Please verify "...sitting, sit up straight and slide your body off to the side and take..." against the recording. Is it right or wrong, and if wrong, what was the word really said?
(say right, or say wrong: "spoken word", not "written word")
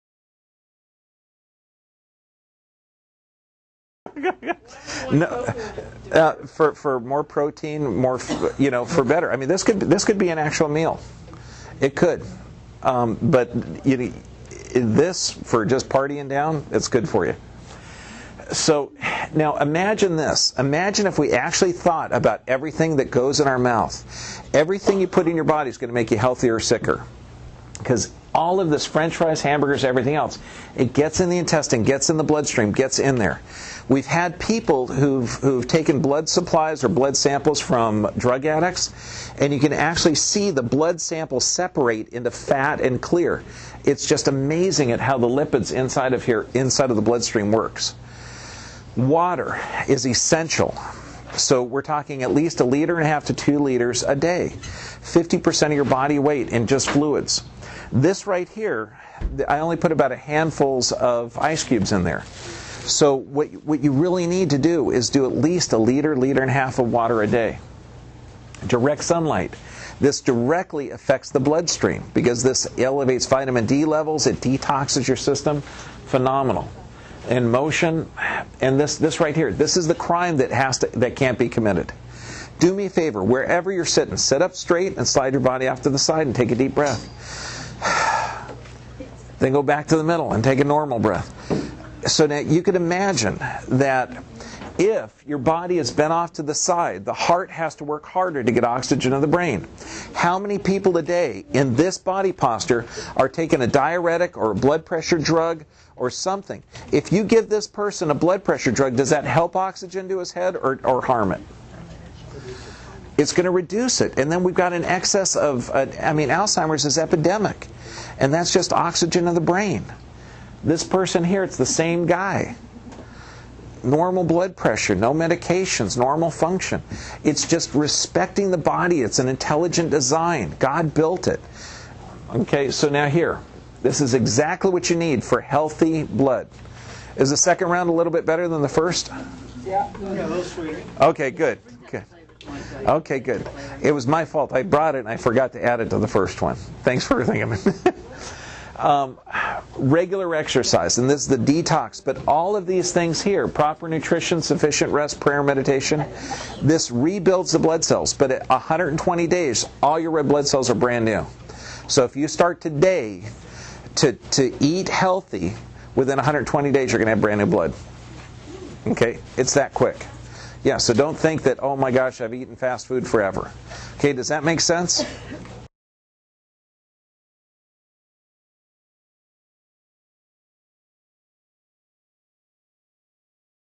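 right.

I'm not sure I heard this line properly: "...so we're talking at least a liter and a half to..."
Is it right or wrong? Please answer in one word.
right.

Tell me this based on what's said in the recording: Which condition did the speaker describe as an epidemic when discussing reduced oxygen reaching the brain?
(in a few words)
Alzheimer's.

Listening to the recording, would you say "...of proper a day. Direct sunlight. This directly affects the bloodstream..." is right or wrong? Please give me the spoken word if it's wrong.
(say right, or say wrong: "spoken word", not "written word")
wrong: "water", not "proper".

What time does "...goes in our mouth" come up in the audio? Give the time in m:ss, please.
0:23.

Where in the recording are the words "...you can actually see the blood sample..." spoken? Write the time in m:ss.
0:39.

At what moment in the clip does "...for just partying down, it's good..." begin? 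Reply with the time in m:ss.
0:15.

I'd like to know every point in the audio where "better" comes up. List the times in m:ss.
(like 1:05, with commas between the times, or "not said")
0:09, 2:18.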